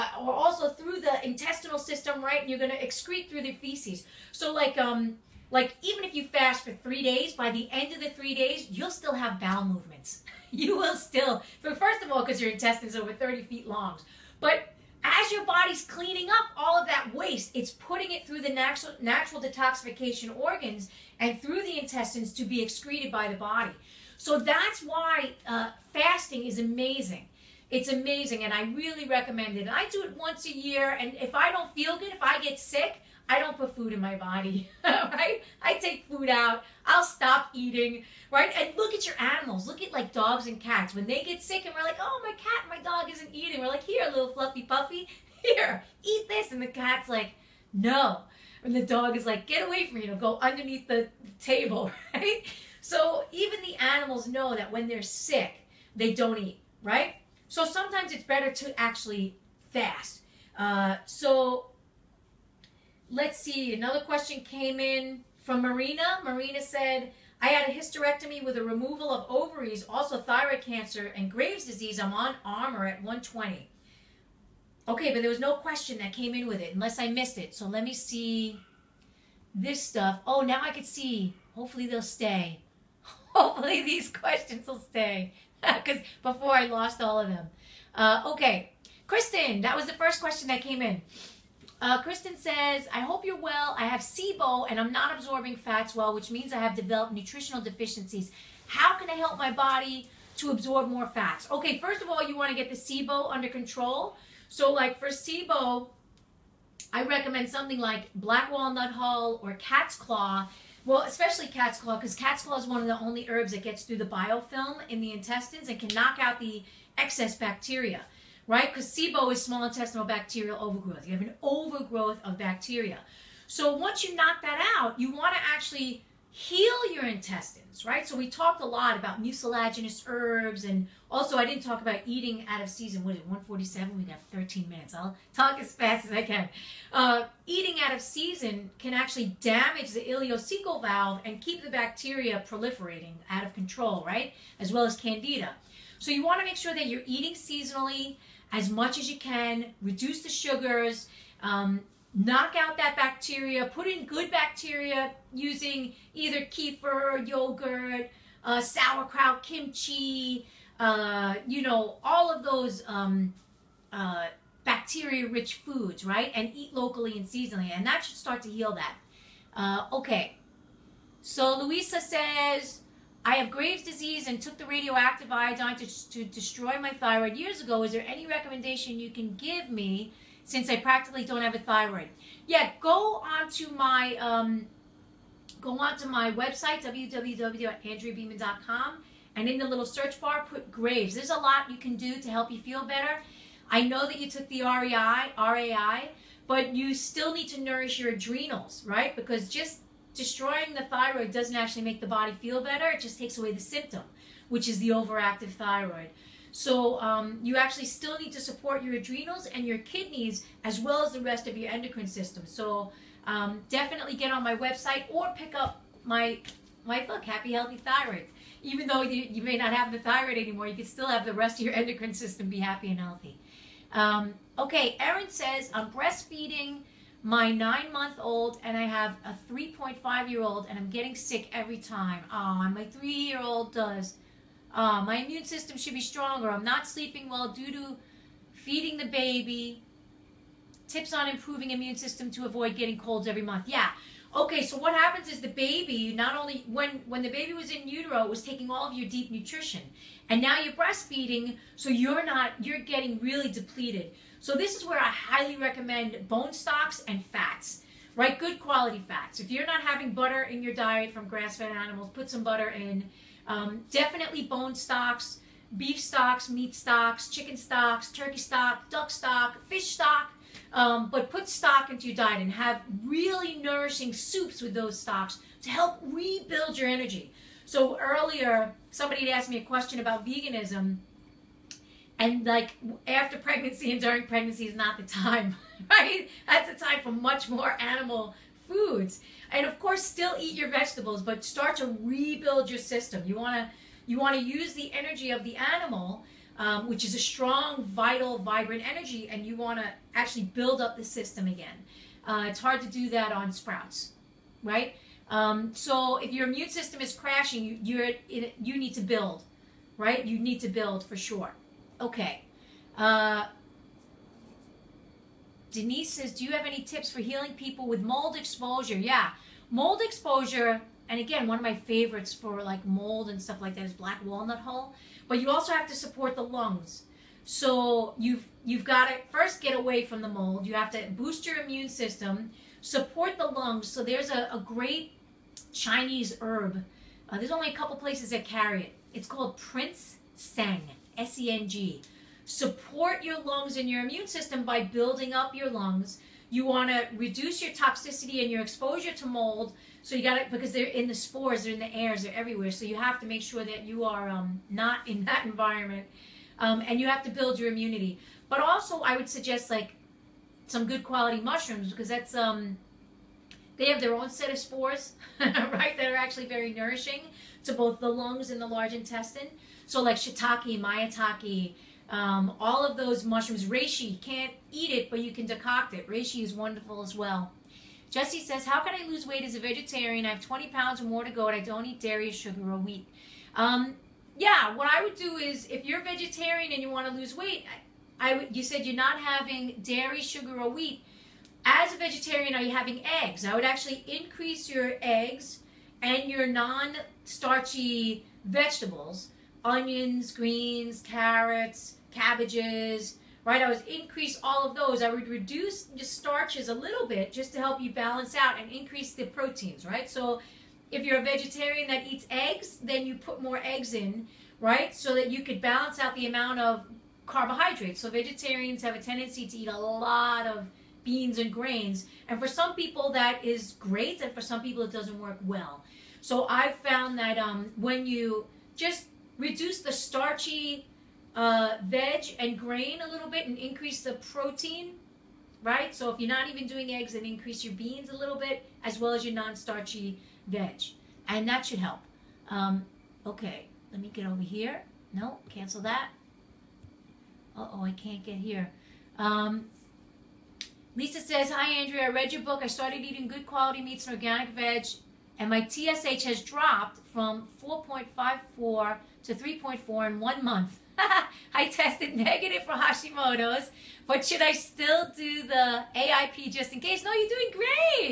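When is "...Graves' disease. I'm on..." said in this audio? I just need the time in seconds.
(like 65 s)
71 s.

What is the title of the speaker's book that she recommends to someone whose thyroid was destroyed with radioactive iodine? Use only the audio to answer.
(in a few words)
Happy Healthy Thyroid.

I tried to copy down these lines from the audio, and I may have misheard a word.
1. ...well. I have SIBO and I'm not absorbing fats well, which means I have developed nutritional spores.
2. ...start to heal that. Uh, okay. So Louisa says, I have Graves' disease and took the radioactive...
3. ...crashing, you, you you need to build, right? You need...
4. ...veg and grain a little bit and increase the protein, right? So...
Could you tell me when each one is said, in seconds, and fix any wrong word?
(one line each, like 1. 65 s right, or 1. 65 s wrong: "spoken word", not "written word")
1. 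93 s wrong: "deficiencies", not "spores"
2. 168 s right
3. 307 s right
4. 431 s right.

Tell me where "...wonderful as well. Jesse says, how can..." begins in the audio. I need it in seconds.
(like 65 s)
376 s.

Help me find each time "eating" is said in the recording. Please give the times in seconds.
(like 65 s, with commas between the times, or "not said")
37 s, 43 s, 132 s, 137 s, 147 s, 453 s.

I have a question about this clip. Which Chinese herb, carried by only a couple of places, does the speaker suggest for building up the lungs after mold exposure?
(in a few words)
Prince Seng.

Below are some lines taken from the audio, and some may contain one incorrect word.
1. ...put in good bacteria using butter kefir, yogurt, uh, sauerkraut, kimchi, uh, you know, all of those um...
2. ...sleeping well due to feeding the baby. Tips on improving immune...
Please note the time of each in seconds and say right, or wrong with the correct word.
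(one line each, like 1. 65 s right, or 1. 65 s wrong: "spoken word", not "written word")
1. 153 s wrong: "either", not "butter"
2. 236 s right.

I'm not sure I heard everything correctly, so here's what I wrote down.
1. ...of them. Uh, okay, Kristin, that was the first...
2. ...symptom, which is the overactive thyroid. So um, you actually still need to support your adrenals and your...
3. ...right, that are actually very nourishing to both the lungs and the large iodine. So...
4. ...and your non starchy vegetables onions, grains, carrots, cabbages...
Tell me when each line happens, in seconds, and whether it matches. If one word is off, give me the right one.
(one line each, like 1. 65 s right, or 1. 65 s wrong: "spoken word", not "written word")
1. 87 s right
2. 203 s right
3. 365 s wrong: "intestine", not "iodine"
4. 396 s wrong: "greens", not "grains".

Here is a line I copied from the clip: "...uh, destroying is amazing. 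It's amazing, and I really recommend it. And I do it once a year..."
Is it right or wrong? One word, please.
wrong.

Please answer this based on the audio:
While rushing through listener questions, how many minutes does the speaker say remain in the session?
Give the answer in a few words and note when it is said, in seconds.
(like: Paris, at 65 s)
13 minutes, at 134 s.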